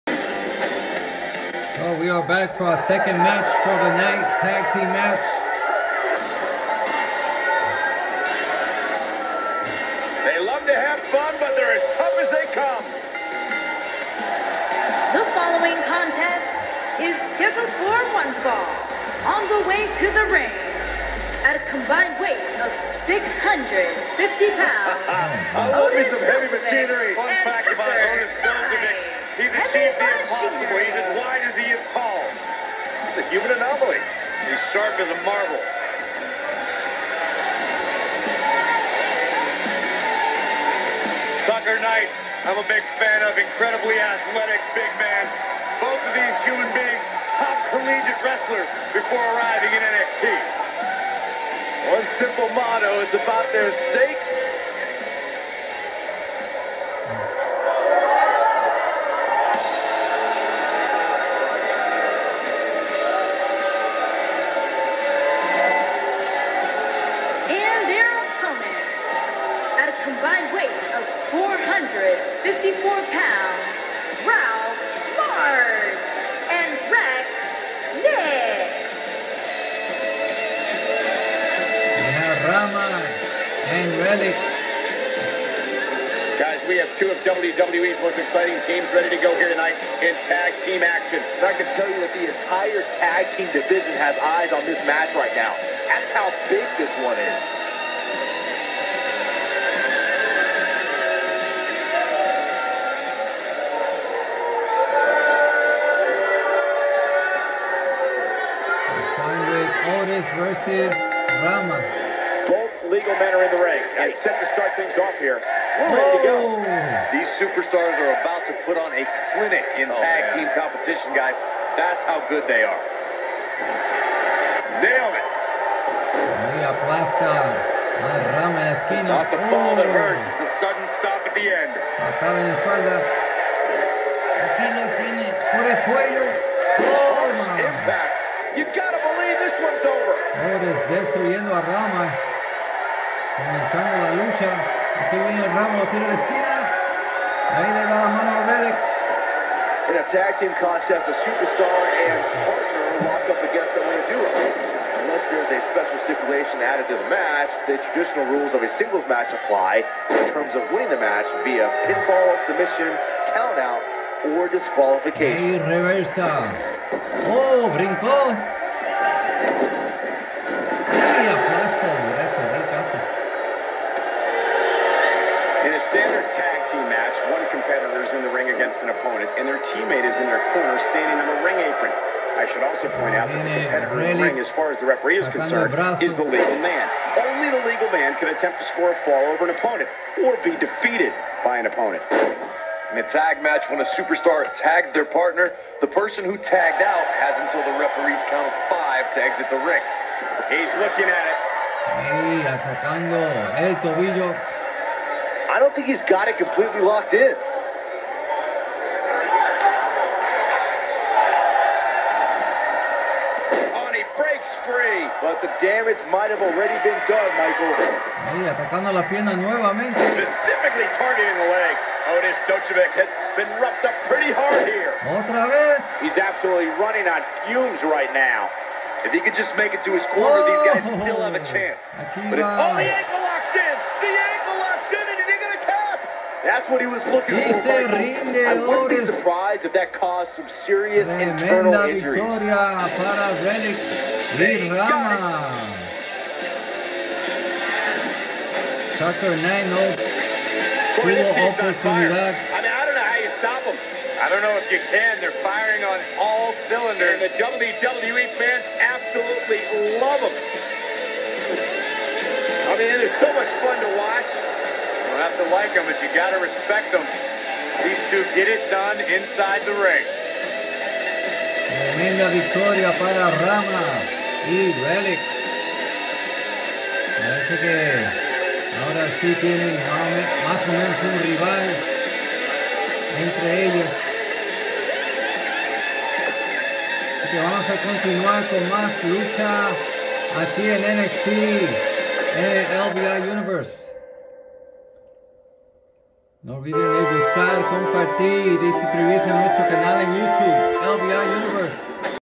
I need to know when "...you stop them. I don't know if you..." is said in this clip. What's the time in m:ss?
4:13.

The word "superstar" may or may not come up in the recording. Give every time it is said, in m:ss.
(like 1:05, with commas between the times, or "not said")
1:57, 2:31, 3:13.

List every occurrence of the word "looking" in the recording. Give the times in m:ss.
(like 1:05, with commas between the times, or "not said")
3:20, 3:57.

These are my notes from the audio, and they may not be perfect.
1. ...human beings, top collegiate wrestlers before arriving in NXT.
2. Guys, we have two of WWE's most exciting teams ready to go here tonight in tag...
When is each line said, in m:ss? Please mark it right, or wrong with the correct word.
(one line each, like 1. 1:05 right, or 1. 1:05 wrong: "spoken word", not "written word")
1. 0:46 right
2. 1:26 right.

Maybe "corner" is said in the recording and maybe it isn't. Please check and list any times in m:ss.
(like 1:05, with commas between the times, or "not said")
3:00, 3:50.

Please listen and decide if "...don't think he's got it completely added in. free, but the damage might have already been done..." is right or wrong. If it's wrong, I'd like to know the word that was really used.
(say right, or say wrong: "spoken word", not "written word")
wrong: "locked", not "added".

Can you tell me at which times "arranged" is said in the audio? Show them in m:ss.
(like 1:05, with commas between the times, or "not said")
not said.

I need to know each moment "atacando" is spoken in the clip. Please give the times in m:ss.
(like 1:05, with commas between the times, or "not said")
3:22, 3:38.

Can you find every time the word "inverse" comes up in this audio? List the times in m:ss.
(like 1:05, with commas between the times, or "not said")
not said.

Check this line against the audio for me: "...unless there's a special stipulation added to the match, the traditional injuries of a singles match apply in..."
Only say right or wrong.
wrong.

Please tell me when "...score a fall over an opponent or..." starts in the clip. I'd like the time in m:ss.
3:08.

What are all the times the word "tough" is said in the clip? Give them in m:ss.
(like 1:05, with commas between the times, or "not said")
0:11.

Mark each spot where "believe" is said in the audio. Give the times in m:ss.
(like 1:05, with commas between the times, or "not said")
2:18.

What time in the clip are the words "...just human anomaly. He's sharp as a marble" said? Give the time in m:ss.
0:30.